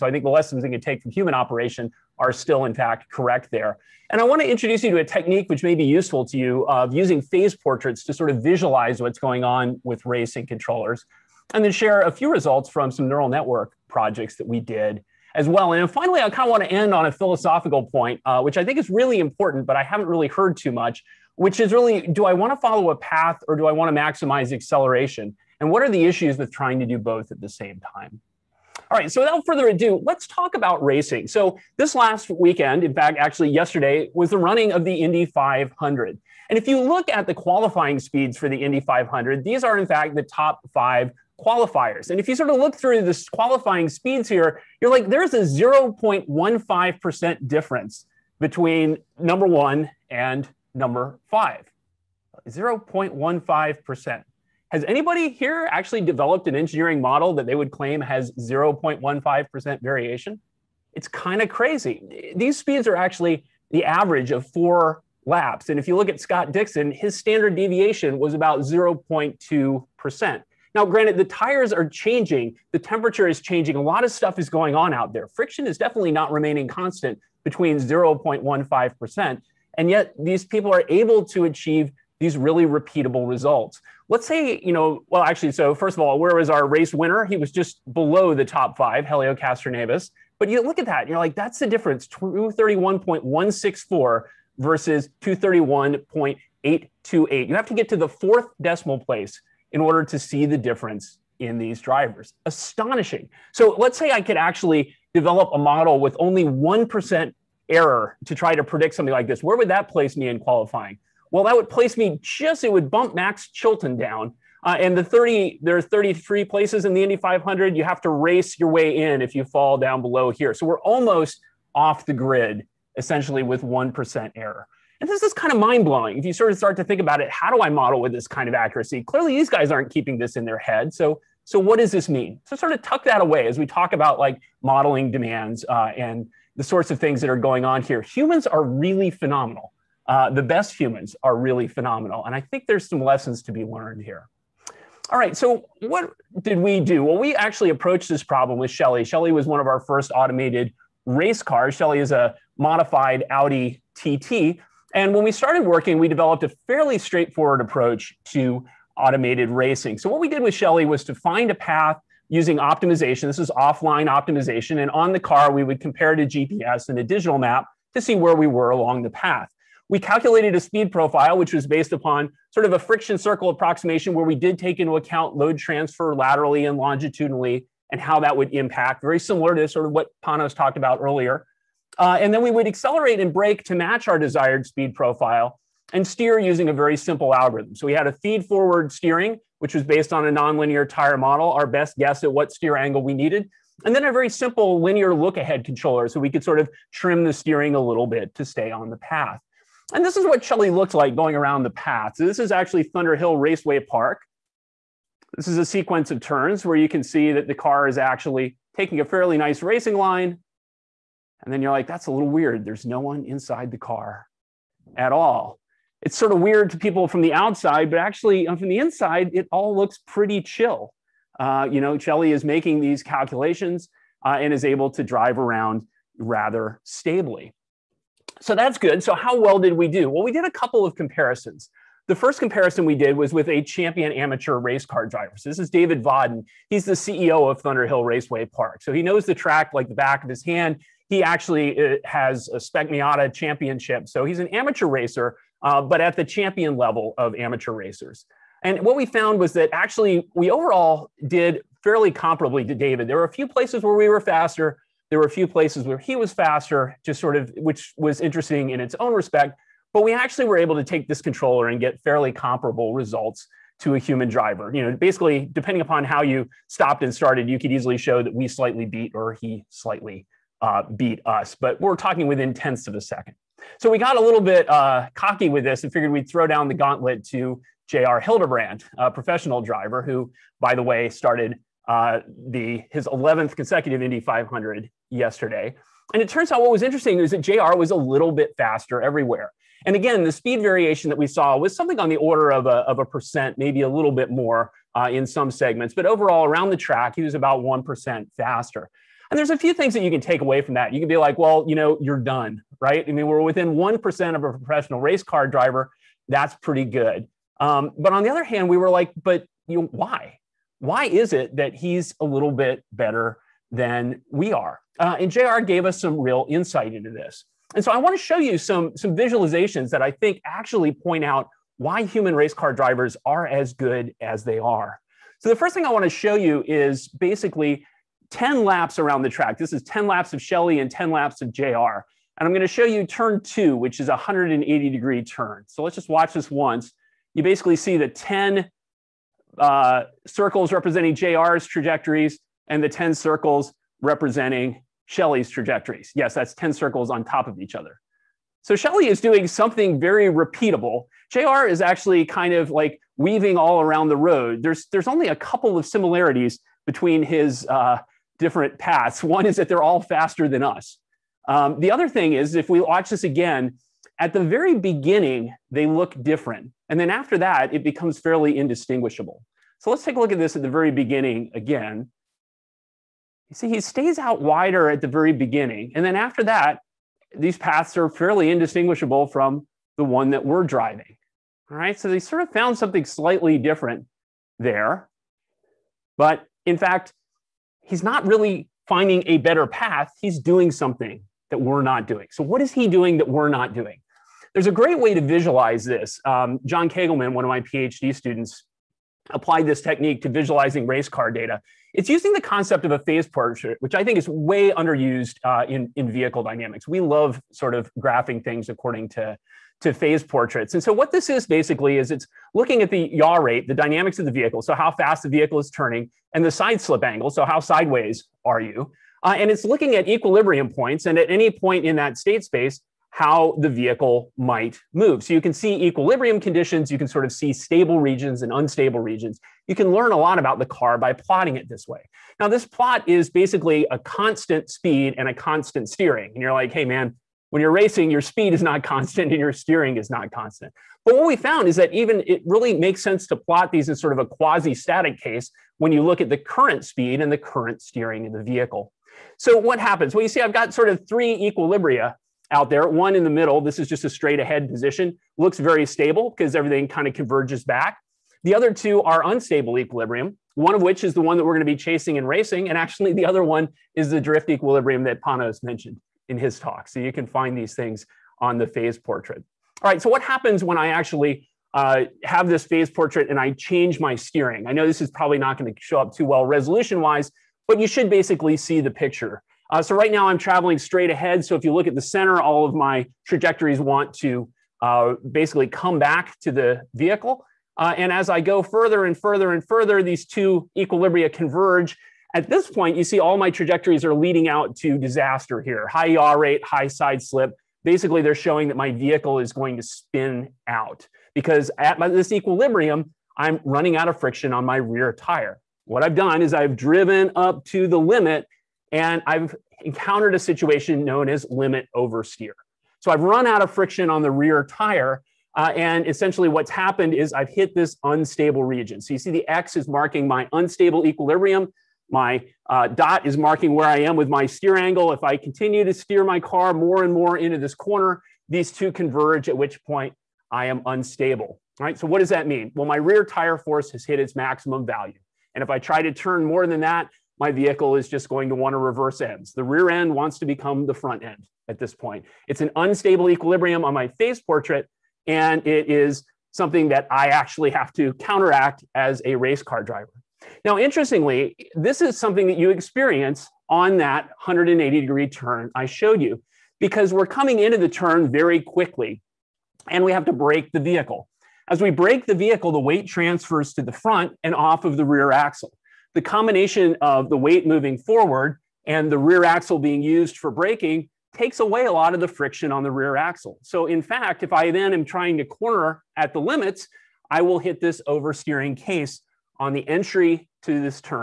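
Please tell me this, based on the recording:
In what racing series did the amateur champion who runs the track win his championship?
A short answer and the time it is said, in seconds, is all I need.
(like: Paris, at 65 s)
Spec Miata, at 242 s.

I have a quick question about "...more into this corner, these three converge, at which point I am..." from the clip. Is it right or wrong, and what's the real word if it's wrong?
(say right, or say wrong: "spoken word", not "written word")
wrong: "two", not "three".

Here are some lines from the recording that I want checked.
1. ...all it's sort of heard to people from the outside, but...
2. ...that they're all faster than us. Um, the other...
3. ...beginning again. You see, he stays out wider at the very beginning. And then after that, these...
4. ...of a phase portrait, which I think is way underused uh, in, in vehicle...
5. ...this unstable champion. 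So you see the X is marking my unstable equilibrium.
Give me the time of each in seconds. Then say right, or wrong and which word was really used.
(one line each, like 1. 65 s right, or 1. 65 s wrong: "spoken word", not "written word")
1. 215 s wrong: "weird", not "heard"
2. 359 s right
3. 370 s right
4. 402 s right
5. 517 s wrong: "region", not "champion".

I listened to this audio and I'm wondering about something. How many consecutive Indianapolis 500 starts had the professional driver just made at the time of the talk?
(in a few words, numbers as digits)
11.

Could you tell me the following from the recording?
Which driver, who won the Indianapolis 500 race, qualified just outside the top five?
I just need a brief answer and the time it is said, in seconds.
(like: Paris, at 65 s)
Helio Castroneves, at 89 s.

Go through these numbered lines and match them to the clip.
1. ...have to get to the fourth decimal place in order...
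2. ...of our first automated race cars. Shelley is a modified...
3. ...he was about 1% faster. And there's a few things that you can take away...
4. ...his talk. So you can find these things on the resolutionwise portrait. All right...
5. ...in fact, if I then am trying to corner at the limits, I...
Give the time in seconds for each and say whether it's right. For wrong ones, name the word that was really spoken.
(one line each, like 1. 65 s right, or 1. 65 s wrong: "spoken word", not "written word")
1. 97 s right
2. 149 s right
3. 297 s right
4. 466 s wrong: "phase", not "resolutionwise"
5. 573 s right.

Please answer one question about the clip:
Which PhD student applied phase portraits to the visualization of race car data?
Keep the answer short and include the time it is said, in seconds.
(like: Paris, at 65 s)
John Kegelman, at 396 s.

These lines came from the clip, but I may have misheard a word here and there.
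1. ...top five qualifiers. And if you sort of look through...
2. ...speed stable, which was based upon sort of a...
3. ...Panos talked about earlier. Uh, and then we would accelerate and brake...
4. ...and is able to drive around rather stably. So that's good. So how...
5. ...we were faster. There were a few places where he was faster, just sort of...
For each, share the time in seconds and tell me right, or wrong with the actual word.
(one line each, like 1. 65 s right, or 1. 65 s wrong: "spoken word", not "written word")
1. 40 s right
2. 170 s wrong: "profile", not "stable"
3. 180 s right
4. 224 s right
5. 253 s right.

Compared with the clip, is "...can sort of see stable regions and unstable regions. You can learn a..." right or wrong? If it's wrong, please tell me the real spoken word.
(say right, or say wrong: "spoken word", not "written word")
right.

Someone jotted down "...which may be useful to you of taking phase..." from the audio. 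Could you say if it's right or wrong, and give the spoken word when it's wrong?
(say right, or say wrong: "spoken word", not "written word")
wrong: "using", not "taking".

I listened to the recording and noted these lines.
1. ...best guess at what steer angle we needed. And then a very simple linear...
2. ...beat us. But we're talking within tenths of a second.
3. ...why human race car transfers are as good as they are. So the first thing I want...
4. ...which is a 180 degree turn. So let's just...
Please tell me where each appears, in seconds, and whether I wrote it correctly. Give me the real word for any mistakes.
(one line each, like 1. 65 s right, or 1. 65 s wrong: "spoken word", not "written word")
1. 191 s right
2. 270 s right
3. 321 s wrong: "drivers", not "transfers"
4. 333 s right.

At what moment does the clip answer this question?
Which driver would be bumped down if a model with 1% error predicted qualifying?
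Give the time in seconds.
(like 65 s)
113 s.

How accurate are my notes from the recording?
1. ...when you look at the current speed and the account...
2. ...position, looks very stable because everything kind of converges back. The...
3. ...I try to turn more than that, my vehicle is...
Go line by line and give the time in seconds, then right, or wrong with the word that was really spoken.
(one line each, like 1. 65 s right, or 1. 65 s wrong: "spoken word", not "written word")
1. 445 s wrong: "current", not "account"
2. 454 s right
3. 535 s right.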